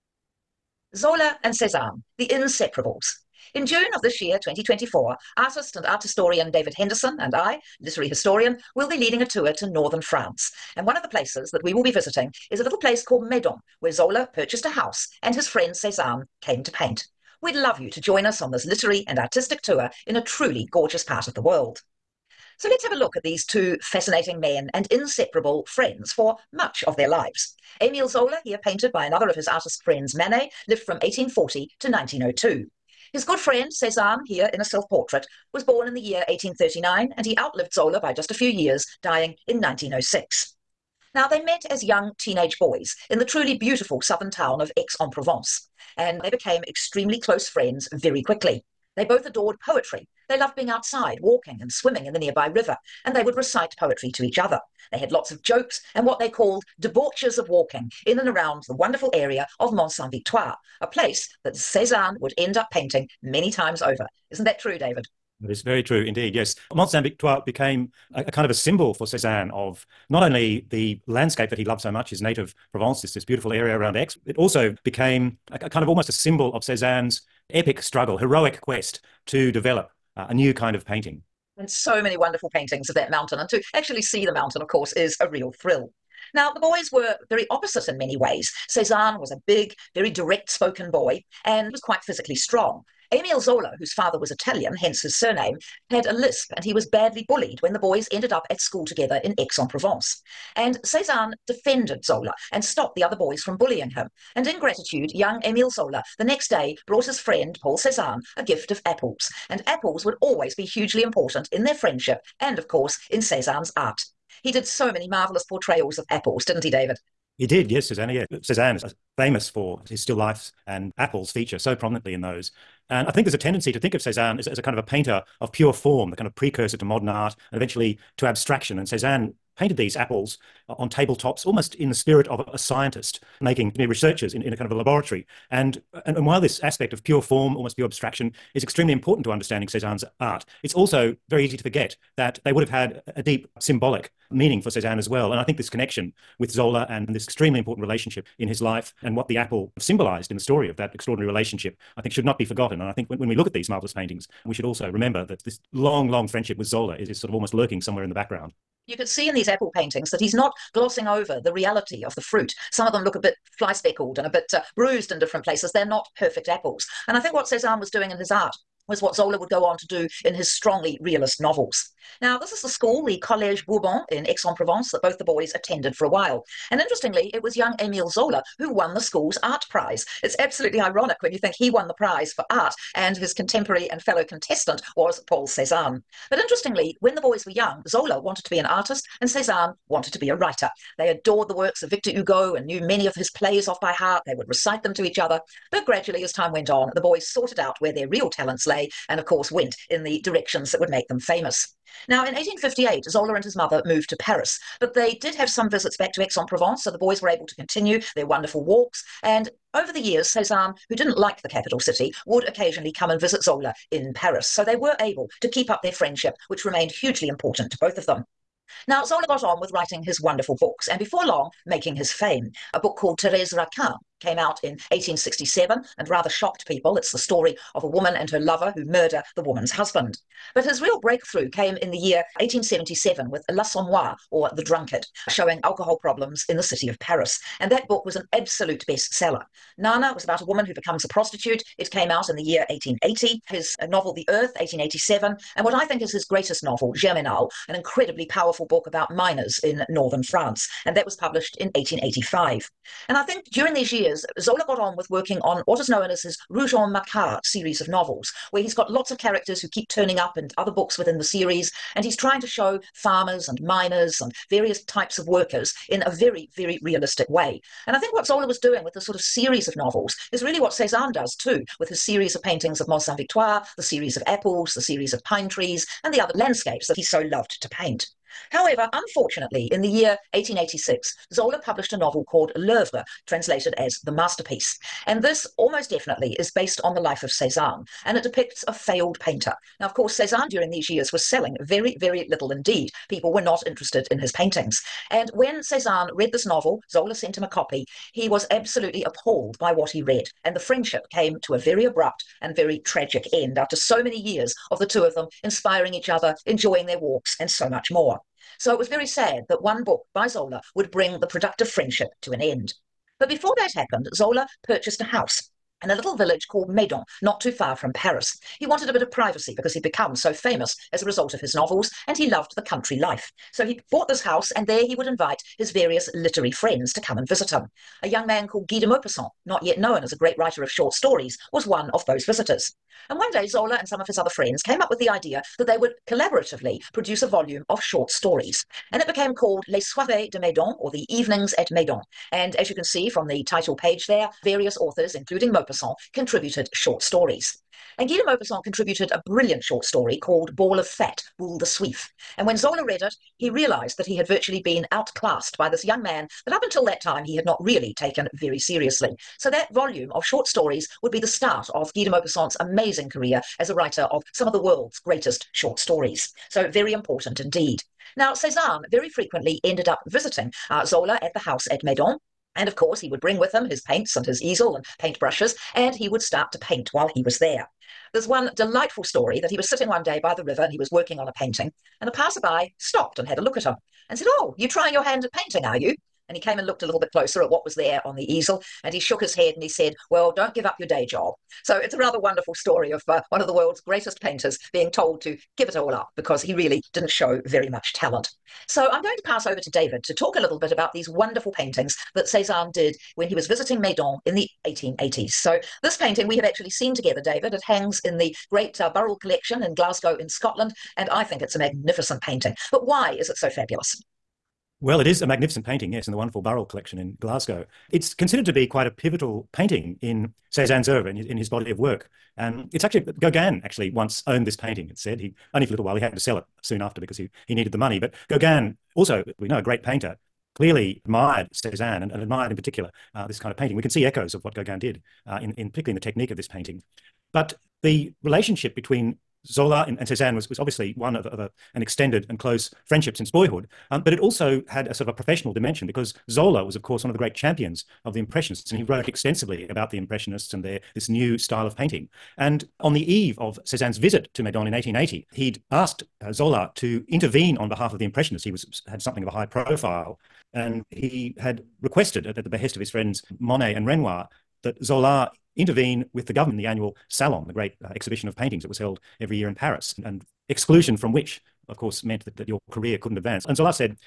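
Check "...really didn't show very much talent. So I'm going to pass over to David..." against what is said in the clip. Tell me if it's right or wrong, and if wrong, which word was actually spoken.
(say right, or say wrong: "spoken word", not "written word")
right.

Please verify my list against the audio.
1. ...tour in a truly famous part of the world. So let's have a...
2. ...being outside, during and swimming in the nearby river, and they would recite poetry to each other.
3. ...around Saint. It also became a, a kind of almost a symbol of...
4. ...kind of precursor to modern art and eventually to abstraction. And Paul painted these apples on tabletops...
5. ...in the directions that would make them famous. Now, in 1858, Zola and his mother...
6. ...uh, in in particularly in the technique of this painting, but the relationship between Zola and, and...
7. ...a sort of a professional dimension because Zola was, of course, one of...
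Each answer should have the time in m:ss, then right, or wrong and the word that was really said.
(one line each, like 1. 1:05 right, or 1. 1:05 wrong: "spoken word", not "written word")
1. 0:19 wrong: "gorgeous", not "famous"
2. 0:50 wrong: "walking", not "during"
3. 1:13 wrong: "Aix", not "Saint"
4. 2:06 wrong: "Cezanne", not "Paul"
5. 3:19 right
6. 7:15 right
7. 7:24 right.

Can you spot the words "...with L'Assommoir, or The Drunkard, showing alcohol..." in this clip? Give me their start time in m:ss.
3:53.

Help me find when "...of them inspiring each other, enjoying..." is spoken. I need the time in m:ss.
5:05.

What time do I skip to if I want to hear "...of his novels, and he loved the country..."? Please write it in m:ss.
5:21.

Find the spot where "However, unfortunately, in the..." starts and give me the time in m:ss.
4:38.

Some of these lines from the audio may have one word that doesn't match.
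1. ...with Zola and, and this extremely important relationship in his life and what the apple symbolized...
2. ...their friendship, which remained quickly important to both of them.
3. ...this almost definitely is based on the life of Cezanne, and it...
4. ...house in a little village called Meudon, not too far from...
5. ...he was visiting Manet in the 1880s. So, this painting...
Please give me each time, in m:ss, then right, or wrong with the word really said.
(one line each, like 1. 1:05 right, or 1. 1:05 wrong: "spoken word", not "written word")
1. 2:26 right
2. 3:35 wrong: "hugely", not "quickly"
3. 4:45 right
4. 5:15 right
5. 6:43 wrong: "Meudon", not "Manet".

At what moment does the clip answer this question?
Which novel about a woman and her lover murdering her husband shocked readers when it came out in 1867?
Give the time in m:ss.
3:43.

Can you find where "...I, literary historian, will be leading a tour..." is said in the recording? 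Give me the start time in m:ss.
0:07.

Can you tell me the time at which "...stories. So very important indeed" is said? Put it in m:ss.
6:05.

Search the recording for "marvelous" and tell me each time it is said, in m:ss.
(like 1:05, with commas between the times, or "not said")
1:55, 2:33.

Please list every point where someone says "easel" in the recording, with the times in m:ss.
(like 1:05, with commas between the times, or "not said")
6:14, 6:28.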